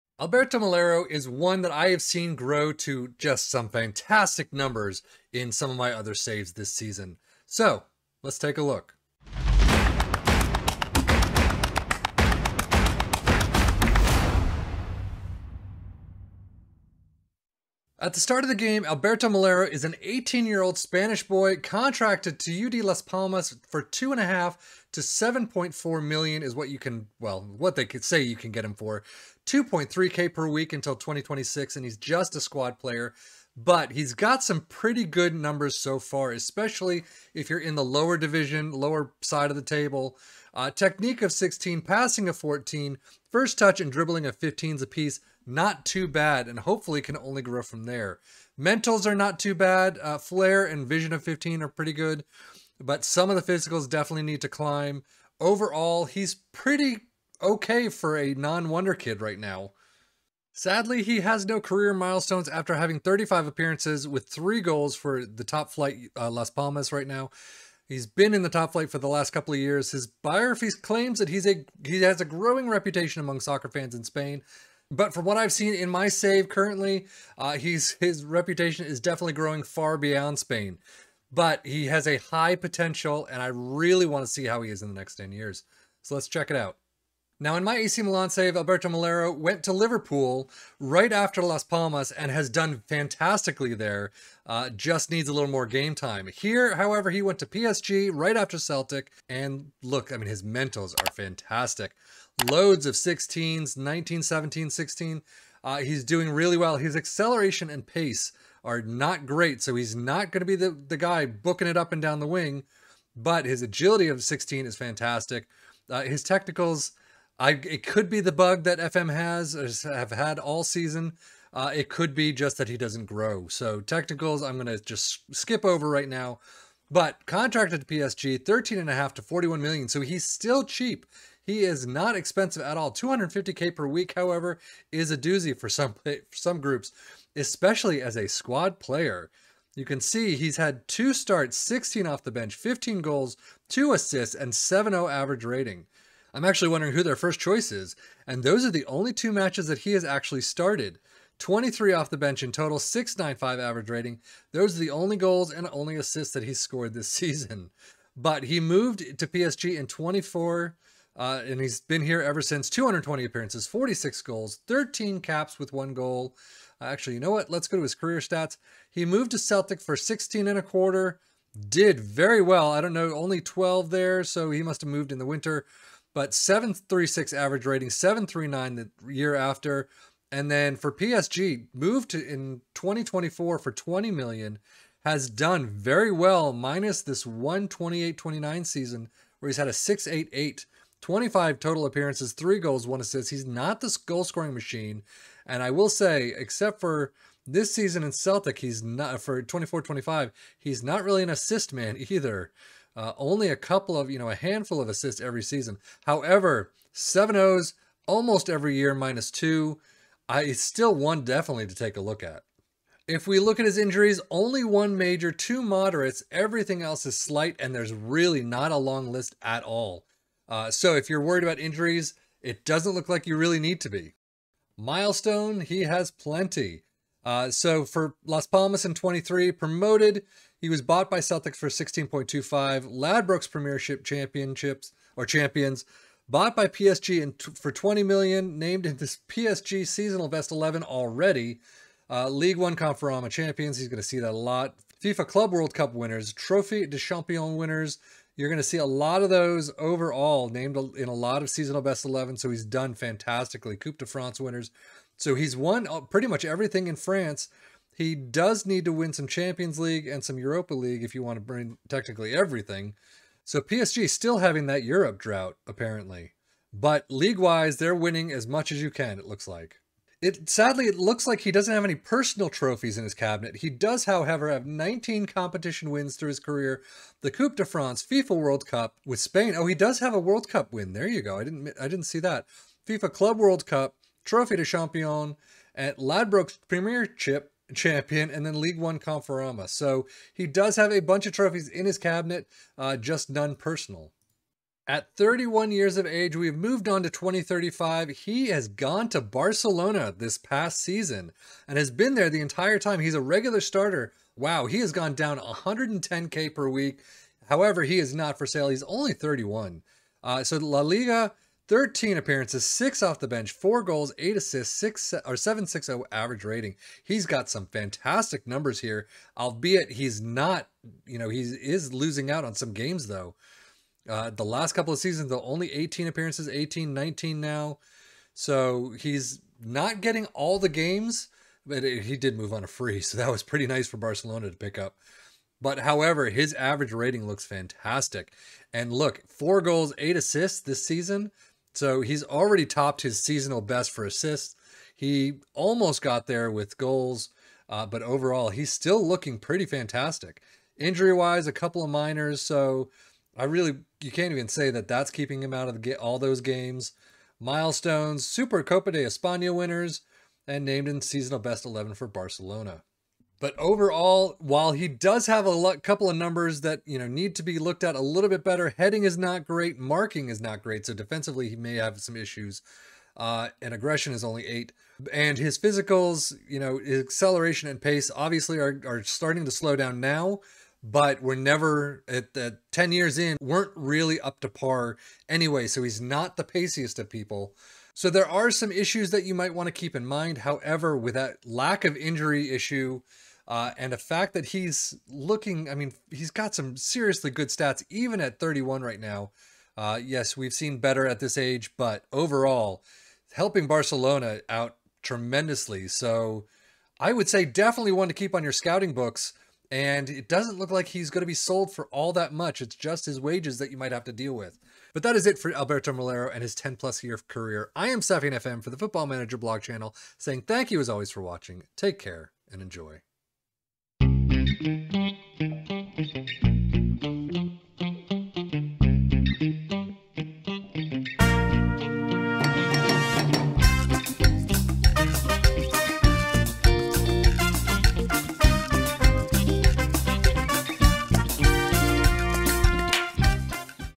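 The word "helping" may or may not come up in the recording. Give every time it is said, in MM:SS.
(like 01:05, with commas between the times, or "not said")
06:43.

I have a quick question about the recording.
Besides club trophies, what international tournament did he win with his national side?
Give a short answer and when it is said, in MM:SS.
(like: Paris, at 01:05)
FIFA World Cup, at 04:38.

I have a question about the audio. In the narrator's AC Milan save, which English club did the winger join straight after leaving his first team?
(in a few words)
Liverpool.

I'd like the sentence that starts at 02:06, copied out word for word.
But contracted to PSG, 13 and a half to 41 million.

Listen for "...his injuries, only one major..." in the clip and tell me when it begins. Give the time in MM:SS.
03:33.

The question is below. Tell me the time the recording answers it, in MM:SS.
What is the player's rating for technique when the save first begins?
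00:40.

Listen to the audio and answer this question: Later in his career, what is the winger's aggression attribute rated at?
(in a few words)
8.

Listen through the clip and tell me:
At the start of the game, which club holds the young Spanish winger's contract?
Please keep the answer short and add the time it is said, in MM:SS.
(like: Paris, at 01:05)
UD Las Palmas, at 00:22.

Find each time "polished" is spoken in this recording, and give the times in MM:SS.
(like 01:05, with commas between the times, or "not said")
not said.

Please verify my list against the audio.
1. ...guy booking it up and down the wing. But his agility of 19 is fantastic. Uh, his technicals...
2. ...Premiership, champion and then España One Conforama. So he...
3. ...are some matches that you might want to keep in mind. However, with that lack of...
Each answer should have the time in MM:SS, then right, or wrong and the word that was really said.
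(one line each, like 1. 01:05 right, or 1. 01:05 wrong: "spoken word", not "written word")
1. 01:50 wrong: "16", not "19"
2. 04:46 wrong: "League", not "España"
3. 06:28 wrong: "issues", not "matches".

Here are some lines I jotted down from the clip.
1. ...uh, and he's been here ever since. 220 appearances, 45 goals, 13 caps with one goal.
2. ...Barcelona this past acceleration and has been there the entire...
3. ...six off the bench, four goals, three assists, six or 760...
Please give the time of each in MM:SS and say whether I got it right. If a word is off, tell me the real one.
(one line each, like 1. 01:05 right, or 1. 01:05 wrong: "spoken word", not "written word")
1. 02:41 wrong: "46", not "45"
2. 04:59 wrong: "season", not "acceleration"
3. 05:12 wrong: "eight", not "three".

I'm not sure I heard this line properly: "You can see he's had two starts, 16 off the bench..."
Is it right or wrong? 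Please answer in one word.
right.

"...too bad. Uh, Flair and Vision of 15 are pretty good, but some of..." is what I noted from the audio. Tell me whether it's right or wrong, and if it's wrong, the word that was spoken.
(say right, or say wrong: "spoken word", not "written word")
right.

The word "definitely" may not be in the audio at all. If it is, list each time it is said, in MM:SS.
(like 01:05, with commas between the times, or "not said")
00:53, 01:18, 03:31, 06:47.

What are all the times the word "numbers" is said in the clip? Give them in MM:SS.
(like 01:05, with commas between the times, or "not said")
00:04, 00:35, 05:18, 06:06.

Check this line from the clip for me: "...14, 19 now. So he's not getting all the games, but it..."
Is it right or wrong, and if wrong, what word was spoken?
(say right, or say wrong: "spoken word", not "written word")
wrong: "18", not "14".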